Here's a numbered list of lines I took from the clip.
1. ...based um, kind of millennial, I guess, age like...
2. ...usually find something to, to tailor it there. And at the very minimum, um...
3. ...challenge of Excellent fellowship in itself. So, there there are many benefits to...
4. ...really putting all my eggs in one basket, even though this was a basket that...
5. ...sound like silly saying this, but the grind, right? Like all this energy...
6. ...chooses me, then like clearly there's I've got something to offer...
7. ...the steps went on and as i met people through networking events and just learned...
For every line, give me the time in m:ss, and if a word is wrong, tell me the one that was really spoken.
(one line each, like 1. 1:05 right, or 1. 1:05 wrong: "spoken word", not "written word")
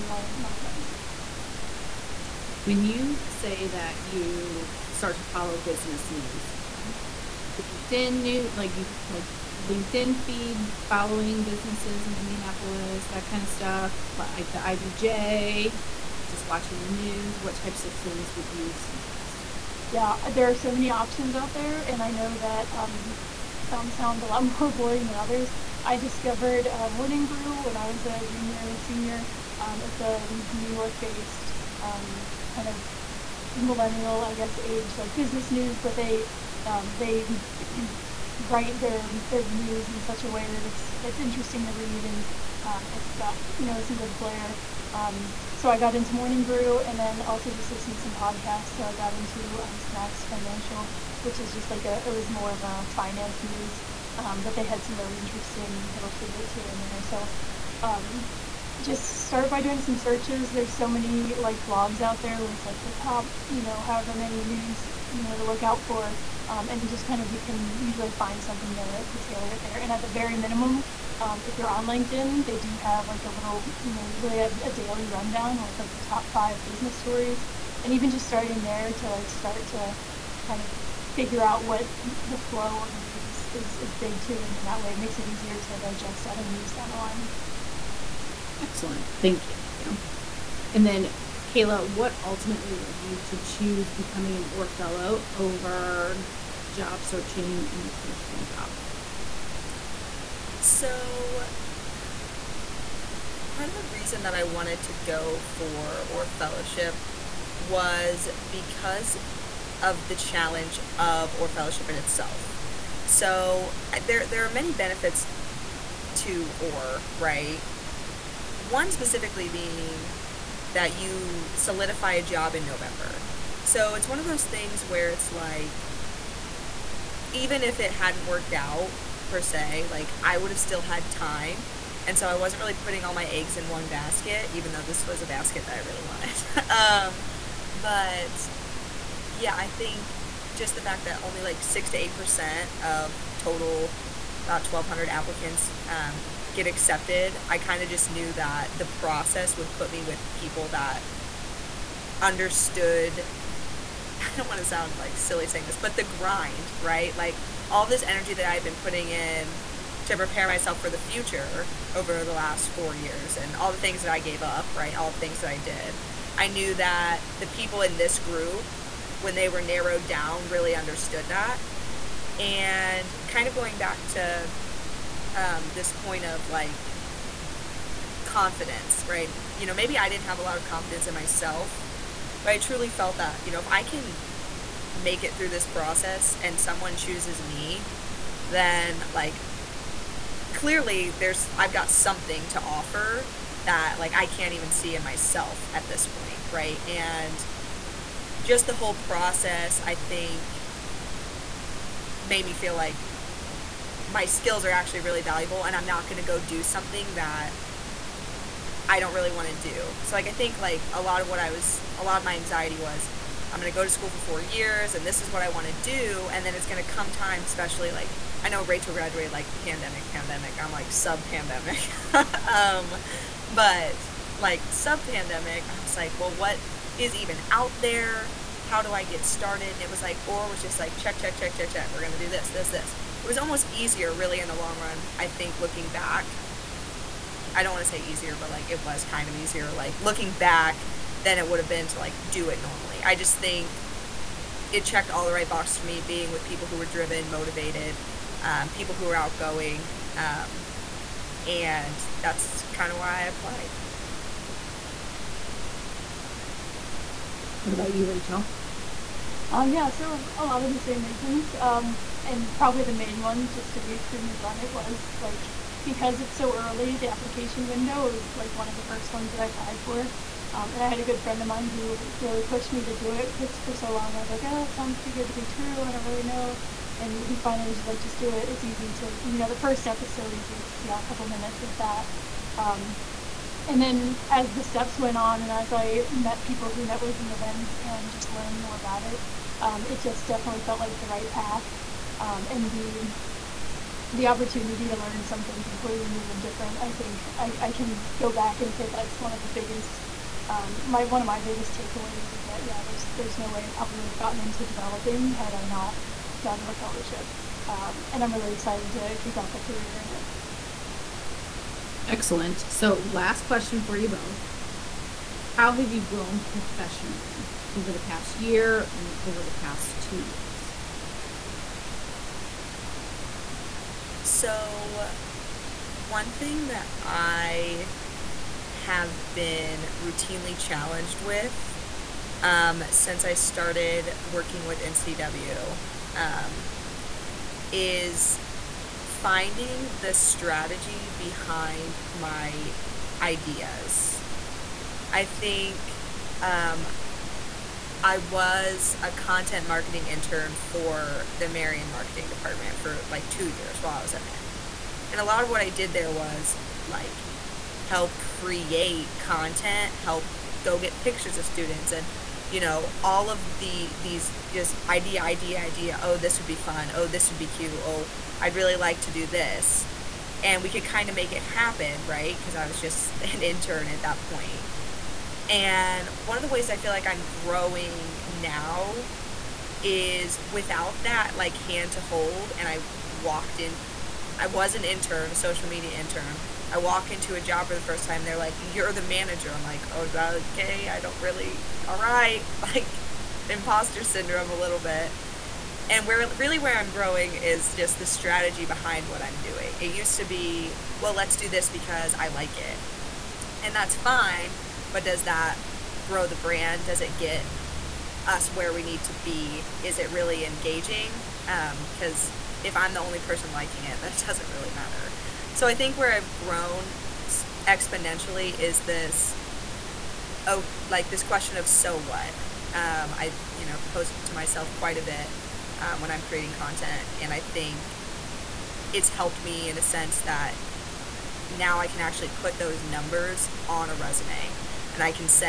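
1. 0:30 right
2. 1:07 right
3. 1:50 wrong: "ORR", not "Excellent"
4. 2:12 right
5. 2:34 right
6. 3:06 right
7. 4:44 right.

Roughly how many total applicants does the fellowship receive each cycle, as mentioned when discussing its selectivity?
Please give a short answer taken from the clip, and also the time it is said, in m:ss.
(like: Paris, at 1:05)
1,200, at 2:24.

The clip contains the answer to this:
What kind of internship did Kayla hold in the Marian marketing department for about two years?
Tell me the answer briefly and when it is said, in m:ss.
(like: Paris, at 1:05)
content marketing intern, at 5:49.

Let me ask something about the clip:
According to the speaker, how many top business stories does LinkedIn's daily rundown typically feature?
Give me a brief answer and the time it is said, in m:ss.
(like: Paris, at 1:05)
5, at 1:16.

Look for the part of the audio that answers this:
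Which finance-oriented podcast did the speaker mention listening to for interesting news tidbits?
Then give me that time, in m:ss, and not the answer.
0:49.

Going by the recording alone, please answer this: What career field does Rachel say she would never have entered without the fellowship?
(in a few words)
developing.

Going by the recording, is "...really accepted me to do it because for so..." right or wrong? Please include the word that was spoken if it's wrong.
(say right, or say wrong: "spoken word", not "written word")
wrong: "pushed", not "accepted".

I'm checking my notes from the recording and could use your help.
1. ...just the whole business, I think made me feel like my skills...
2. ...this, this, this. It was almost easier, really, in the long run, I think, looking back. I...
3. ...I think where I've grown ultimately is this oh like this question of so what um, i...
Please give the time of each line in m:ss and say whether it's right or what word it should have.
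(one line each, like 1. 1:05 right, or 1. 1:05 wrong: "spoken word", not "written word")
1. 3:18 wrong: "process", not "business"
2. 3:52 right
3. 6:55 wrong: "exponentially", not "ultimately".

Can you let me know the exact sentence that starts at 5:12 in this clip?
So, last question for you both.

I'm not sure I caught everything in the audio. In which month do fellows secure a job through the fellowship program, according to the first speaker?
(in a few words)
November.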